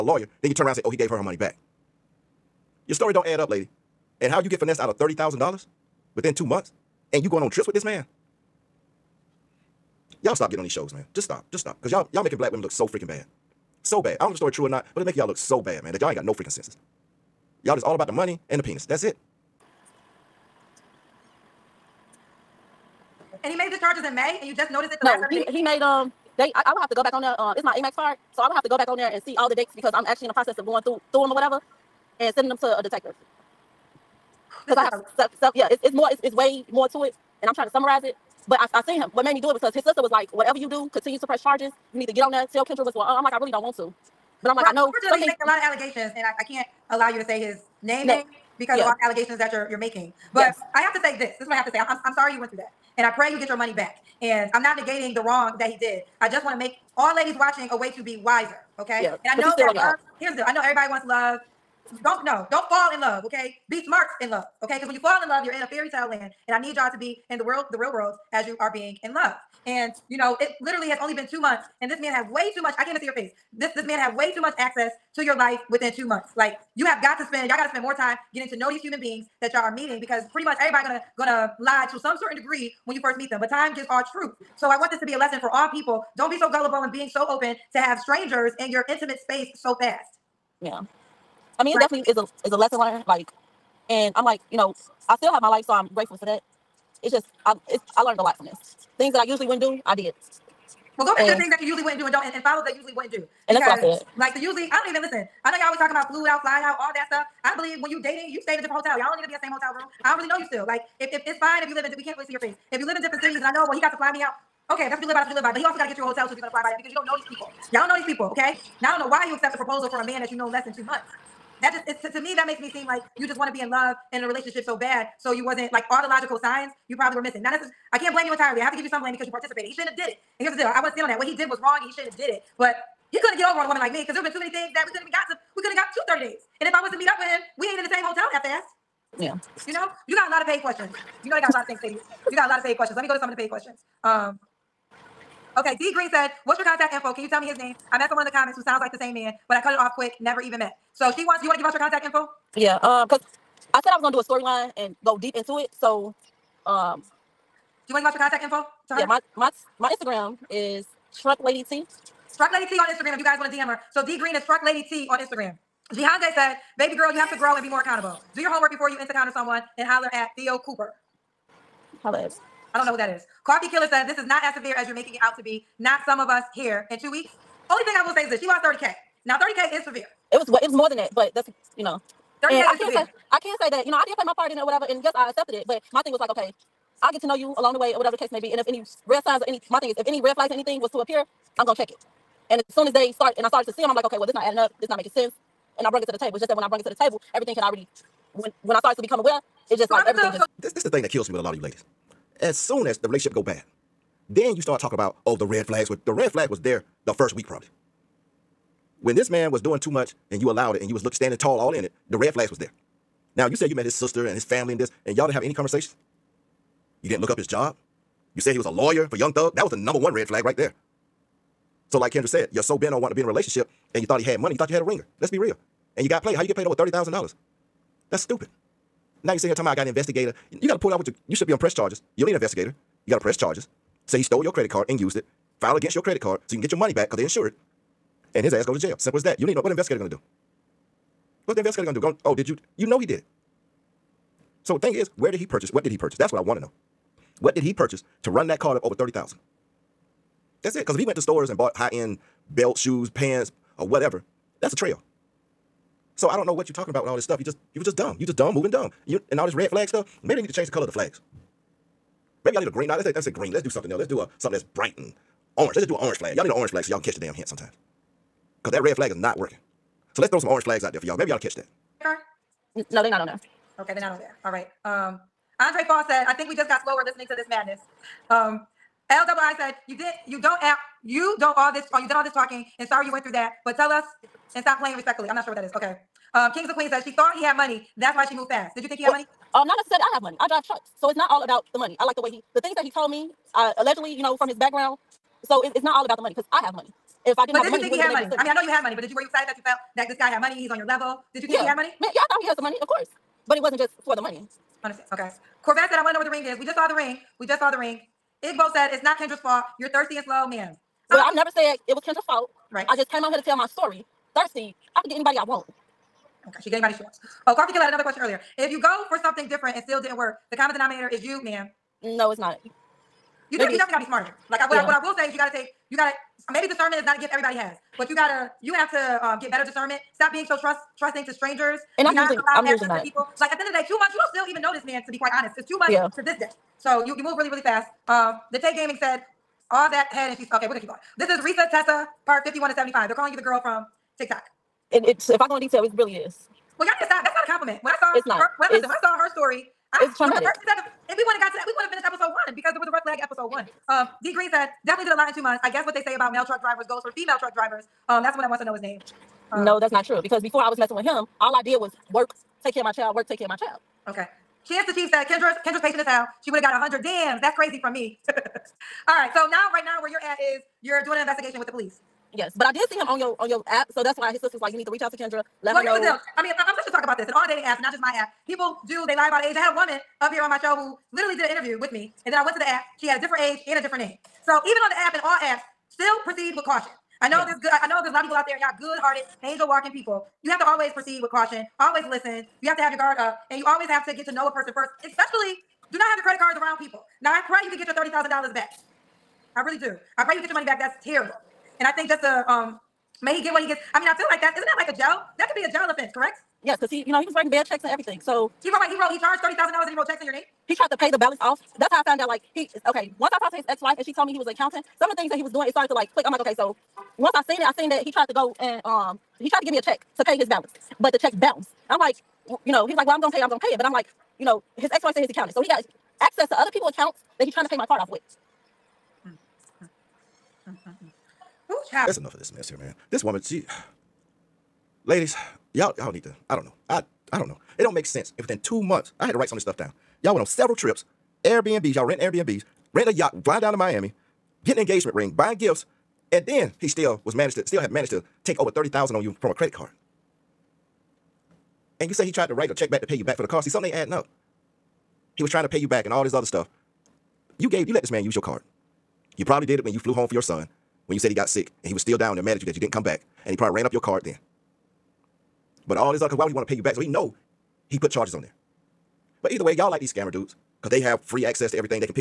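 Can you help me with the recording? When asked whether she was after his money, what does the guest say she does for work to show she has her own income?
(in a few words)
Drive trucks.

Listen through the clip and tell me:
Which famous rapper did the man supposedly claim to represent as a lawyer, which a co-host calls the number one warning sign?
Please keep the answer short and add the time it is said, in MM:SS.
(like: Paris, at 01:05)
Young Thug, at 03:39.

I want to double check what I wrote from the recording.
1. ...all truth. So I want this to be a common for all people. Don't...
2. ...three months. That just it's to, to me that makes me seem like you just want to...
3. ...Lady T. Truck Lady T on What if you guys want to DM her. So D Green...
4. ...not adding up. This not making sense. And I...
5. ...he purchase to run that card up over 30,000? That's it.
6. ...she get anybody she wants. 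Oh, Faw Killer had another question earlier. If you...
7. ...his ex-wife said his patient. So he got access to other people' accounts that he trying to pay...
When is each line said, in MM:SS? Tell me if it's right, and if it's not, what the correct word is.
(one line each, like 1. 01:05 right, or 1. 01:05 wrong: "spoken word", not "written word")
1. 01:23 wrong: "lesson", not "common"
2. 02:00 wrong: "two", not "three"
3. 02:41 wrong: "Instagram", not "What"
4. 03:14 right
5. 04:07 right
6. 05:16 wrong: "Coffee", not "Faw"
7. 07:04 wrong: "accountant", not "patient".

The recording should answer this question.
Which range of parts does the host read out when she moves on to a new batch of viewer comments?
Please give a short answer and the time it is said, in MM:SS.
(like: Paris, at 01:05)
51 to 75, at 05:42.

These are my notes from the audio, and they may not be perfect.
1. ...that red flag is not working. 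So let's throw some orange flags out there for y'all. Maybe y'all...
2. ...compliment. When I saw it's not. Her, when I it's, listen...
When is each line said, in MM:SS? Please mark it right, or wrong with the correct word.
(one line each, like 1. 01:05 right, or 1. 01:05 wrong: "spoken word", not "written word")
1. 04:28 right
2. 05:47 right.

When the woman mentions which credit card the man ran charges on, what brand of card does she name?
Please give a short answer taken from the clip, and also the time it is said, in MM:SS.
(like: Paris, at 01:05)
Amex, at 00:27.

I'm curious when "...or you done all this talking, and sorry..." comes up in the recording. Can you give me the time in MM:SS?
04:41.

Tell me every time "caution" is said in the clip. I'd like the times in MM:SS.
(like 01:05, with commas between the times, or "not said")
06:26, 06:31.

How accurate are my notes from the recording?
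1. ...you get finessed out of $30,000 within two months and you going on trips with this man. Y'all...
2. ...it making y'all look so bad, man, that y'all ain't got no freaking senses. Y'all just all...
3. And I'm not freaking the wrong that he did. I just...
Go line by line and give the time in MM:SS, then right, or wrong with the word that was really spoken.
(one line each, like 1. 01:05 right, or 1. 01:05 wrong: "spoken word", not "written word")
1. 00:04 right
2. 00:15 right
3. 00:54 wrong: "negating", not "freaking".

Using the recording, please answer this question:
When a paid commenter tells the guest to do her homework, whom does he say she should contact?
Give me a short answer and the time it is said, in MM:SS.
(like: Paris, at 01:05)
Theo Cooper, at 02:50.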